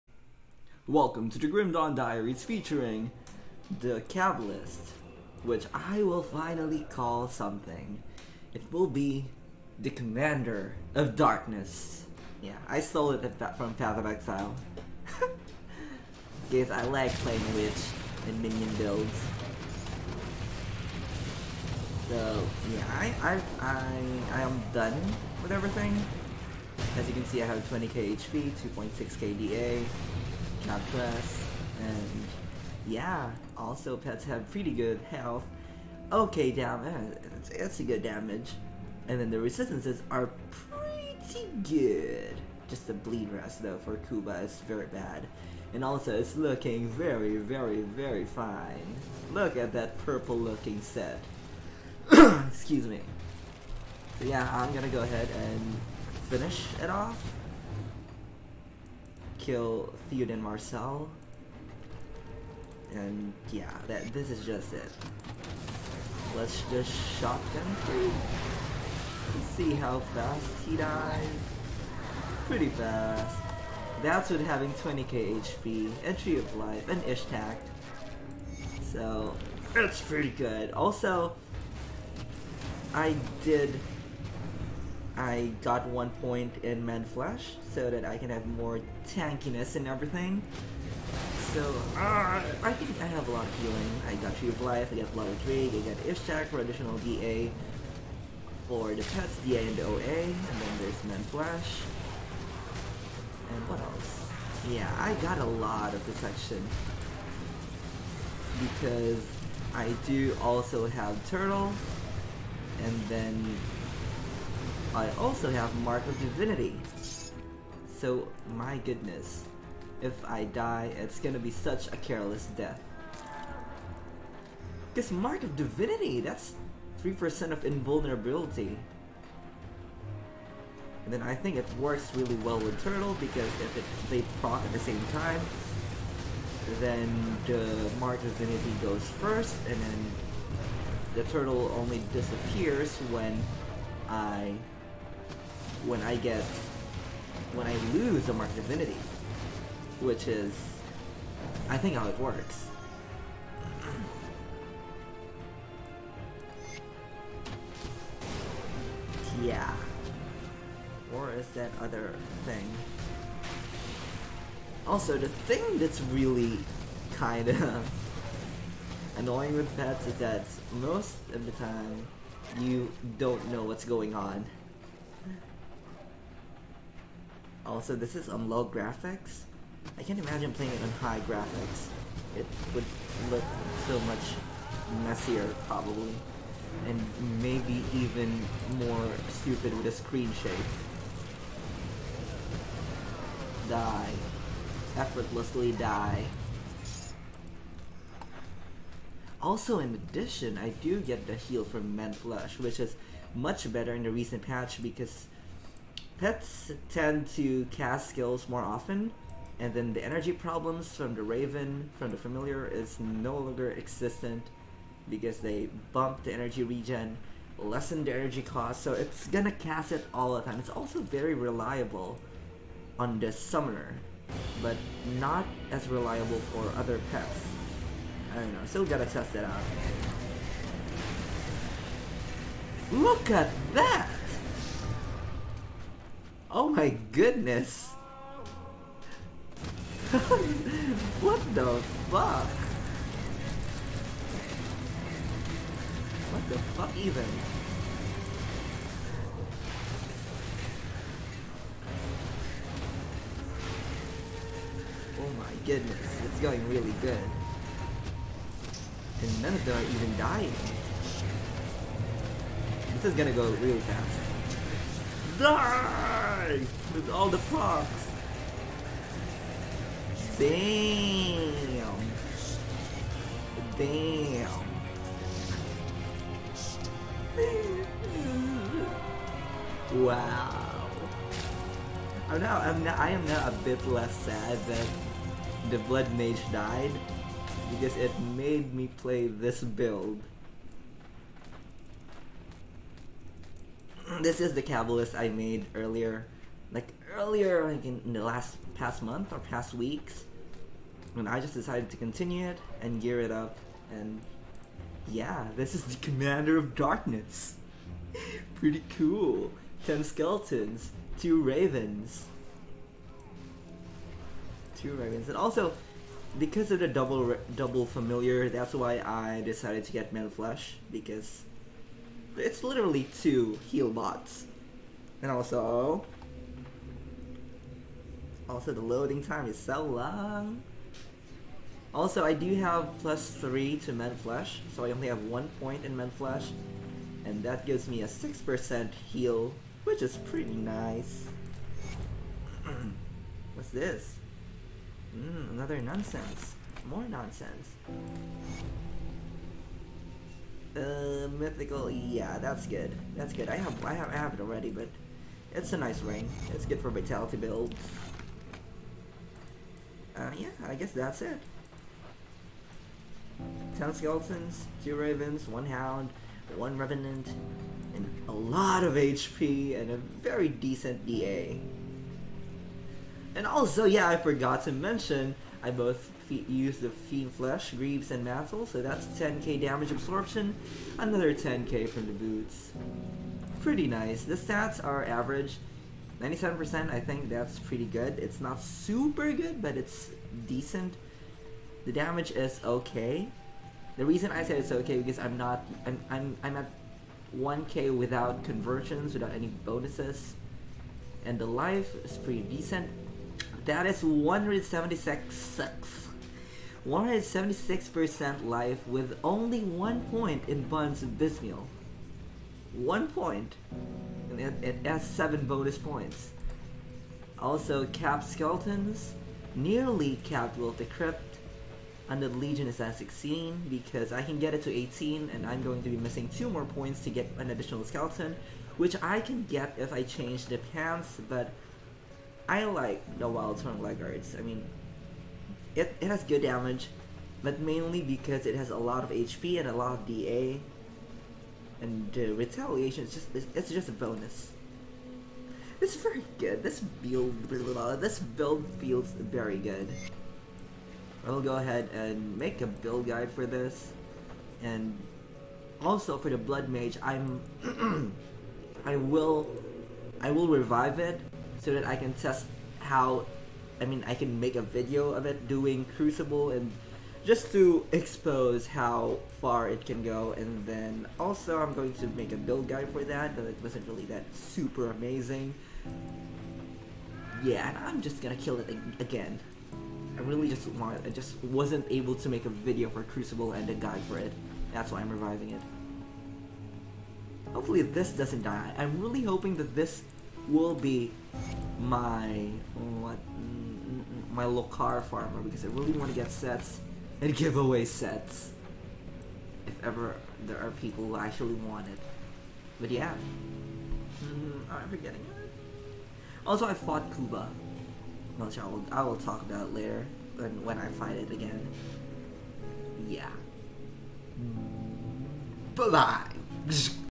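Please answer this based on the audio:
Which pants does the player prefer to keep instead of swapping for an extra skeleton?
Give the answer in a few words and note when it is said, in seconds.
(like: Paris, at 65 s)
Wild Tongue Laggards, at 433 s.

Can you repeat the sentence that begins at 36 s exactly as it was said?
Okay damage, eh, it's, a good damage.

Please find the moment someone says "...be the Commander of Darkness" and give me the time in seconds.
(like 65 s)
8 s.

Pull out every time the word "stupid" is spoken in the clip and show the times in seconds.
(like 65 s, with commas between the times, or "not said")
189 s.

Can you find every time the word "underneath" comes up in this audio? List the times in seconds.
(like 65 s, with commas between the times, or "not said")
not said.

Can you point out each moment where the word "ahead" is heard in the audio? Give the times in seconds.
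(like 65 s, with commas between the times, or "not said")
55 s, 451 s.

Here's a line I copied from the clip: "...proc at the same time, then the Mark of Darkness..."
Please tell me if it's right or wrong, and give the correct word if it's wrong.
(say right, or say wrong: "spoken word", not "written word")
wrong: "Divinity", not "Darkness".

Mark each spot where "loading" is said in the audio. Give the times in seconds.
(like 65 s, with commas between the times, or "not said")
328 s.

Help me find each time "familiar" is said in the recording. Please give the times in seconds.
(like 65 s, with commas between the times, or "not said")
212 s, 317 s.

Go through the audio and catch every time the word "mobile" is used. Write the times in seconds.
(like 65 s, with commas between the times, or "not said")
not said.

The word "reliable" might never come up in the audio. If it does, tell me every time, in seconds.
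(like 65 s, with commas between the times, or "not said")
221 s, 225 s.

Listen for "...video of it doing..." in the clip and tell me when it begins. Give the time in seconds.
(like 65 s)
464 s.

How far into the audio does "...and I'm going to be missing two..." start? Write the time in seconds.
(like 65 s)
425 s.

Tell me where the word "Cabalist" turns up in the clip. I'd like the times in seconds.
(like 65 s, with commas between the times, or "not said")
4 s, 294 s.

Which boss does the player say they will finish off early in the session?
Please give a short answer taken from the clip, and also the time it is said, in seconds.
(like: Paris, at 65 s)
Theodin Marcell, at 60 s.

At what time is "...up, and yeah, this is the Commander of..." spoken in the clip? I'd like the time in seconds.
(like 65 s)
303 s.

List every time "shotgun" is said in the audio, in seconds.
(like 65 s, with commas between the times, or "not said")
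67 s.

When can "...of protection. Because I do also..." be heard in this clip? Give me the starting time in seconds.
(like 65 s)
105 s.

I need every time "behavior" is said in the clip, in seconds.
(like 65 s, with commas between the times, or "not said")
not said.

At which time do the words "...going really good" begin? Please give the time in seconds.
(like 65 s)
256 s.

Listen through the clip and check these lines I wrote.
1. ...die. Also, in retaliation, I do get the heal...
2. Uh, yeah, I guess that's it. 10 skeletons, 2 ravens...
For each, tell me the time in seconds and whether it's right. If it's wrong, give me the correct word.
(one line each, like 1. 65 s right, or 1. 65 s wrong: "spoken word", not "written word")
1. 195 s wrong: "addition", not "retaliation"
2. 360 s right.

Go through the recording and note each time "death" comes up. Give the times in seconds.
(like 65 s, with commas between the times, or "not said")
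122 s.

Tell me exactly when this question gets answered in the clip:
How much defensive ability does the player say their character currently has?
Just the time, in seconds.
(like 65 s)
28 s.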